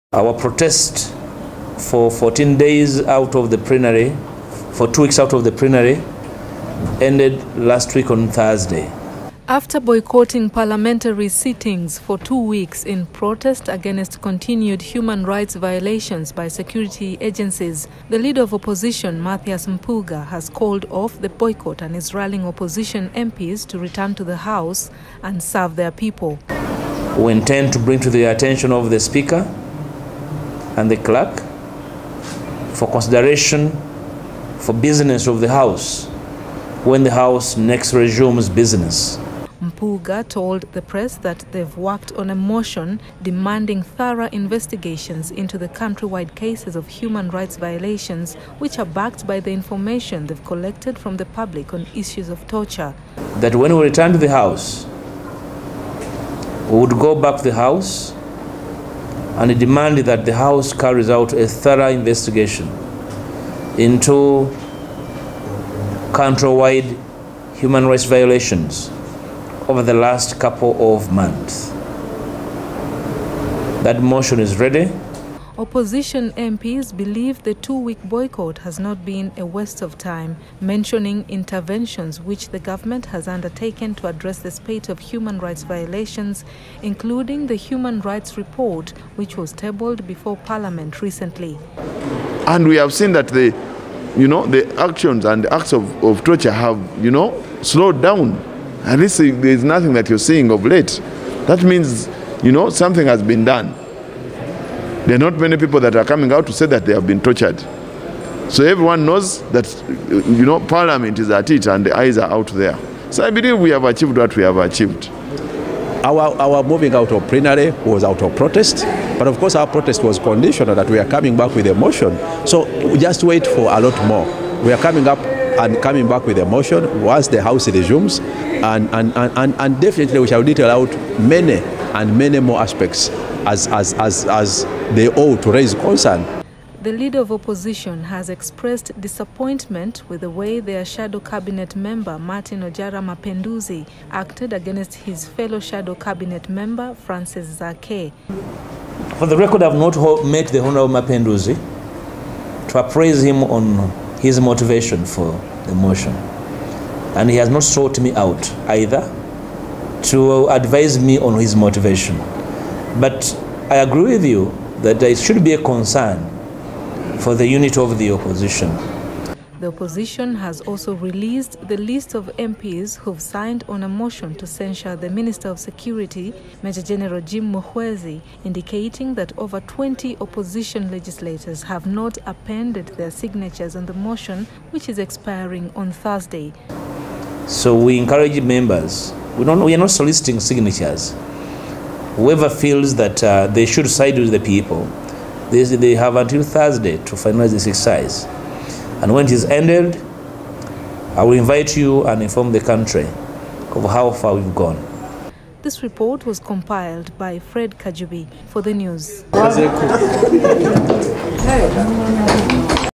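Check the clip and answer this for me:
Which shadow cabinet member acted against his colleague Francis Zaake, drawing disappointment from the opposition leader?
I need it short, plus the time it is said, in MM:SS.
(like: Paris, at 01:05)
Martin Ojara Mapenduzi, at 02:22.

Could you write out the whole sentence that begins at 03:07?
So we encourage members we, don't, we are not soliciting signatures.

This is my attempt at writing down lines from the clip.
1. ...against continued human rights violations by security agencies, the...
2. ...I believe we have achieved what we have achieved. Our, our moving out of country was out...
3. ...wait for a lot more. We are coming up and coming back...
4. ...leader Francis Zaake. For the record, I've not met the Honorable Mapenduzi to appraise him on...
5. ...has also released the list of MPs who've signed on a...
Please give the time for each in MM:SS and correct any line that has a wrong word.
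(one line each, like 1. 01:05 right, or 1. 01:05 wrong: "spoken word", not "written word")
1. 00:13 right
2. 01:53 wrong: "plenary", not "country"
3. 02:03 right
4. 02:26 wrong: "member", not "leader"
5. 02:50 right.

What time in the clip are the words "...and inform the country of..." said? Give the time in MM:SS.
03:22.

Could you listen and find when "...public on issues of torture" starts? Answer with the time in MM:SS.
00:51.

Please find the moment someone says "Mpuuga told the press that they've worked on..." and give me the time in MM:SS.
00:39.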